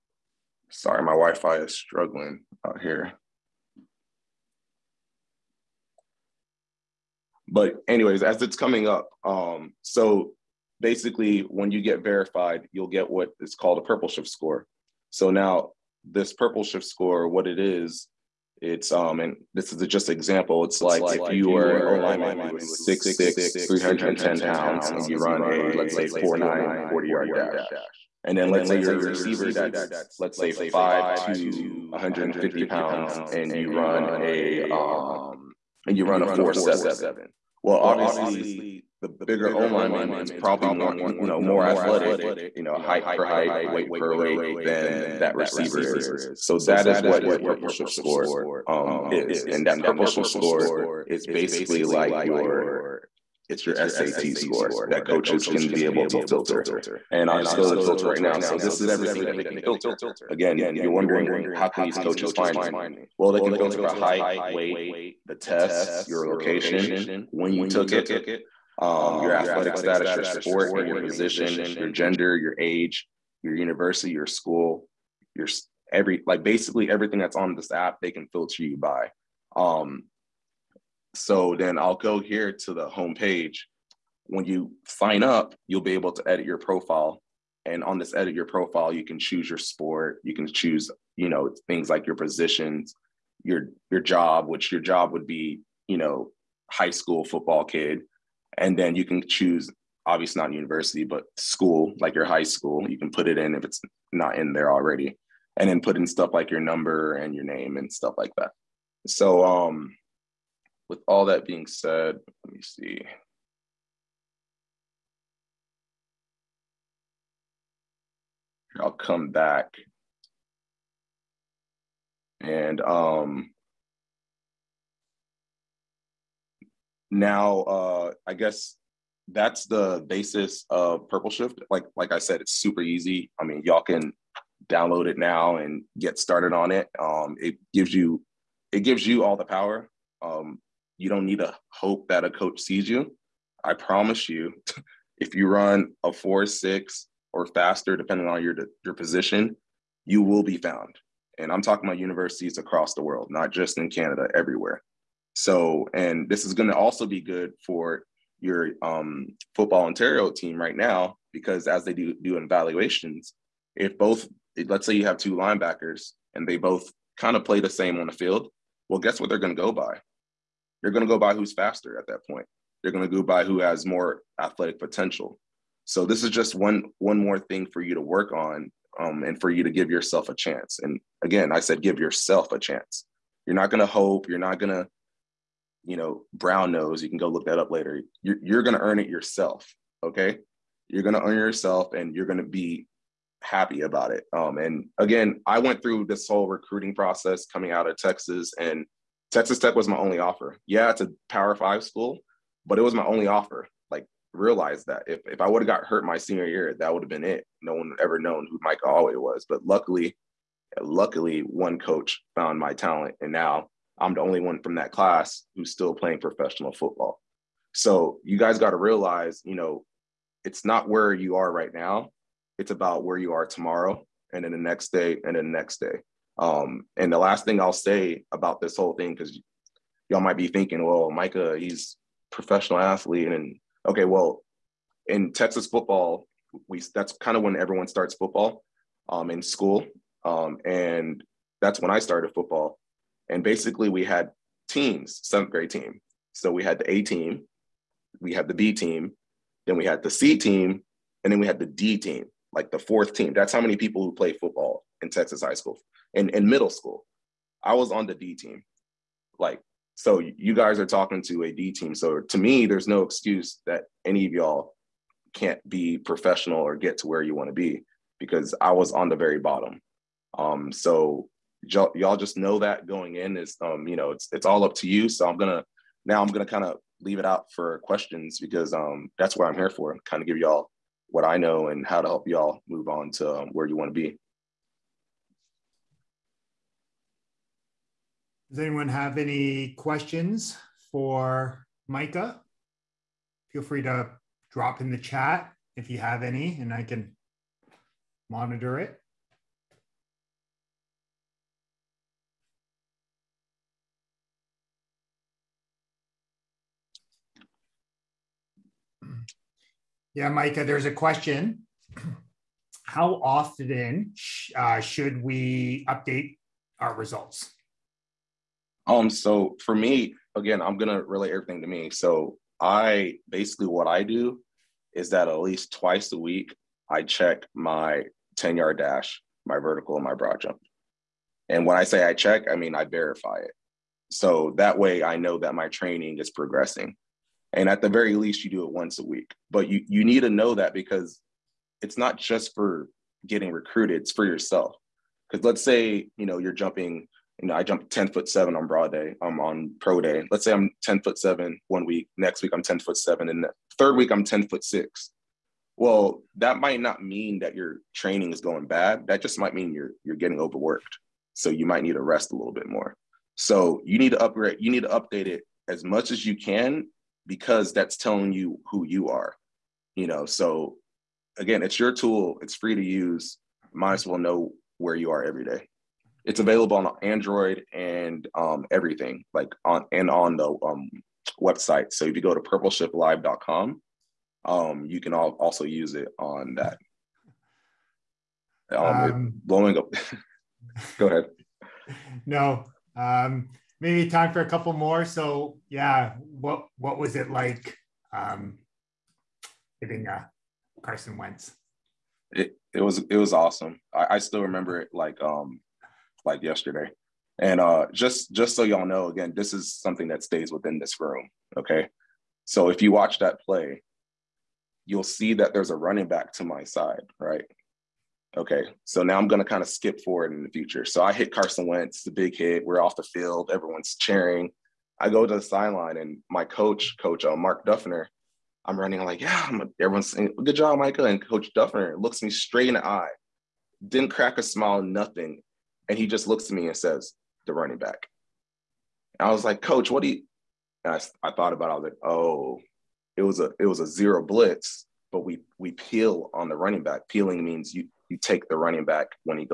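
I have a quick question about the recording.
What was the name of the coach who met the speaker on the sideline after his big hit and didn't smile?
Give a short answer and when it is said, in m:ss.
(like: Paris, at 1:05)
Mark Duffner, at 7:07.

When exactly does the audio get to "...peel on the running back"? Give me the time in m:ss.
7:25.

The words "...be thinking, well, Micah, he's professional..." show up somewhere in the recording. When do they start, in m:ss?
3:50.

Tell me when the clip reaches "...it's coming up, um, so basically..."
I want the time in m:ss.
0:08.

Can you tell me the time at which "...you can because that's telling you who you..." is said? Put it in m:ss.
6:06.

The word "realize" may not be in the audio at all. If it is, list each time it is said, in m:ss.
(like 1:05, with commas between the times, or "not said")
3:24, 3:38.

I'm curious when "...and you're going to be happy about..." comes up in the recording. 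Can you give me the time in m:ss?
3:11.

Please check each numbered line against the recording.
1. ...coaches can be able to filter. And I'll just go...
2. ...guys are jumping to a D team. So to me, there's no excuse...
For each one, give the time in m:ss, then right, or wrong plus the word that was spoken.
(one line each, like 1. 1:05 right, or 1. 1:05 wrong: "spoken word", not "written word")
1. 0:55 right
2. 4:20 wrong: "talking", not "jumping".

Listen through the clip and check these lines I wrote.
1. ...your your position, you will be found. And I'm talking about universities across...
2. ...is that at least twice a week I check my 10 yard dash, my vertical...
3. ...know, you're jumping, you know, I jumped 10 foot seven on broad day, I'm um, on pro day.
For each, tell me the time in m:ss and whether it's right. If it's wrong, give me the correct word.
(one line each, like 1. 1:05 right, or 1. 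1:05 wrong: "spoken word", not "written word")
1. 2:28 right
2. 5:24 right
3. 5:46 right.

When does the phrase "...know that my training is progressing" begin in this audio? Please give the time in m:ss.
5:35.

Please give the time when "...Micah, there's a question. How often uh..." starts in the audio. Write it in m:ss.
5:10.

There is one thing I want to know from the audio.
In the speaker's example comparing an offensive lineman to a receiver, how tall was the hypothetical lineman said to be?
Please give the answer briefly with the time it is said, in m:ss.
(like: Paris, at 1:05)
6'6, at 0:22.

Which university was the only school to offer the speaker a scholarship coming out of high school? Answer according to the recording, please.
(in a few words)
Texas Tech.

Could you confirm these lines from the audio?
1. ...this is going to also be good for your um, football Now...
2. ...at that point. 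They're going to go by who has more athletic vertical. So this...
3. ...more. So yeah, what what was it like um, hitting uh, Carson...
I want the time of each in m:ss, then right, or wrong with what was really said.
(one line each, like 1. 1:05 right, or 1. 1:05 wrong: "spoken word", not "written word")
1. 2:36 wrong: "Ontario", not "Now"
2. 2:51 wrong: "potential", not "vertical"
3. 6:34 right.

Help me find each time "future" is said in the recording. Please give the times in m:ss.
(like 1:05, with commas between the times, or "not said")
7:00.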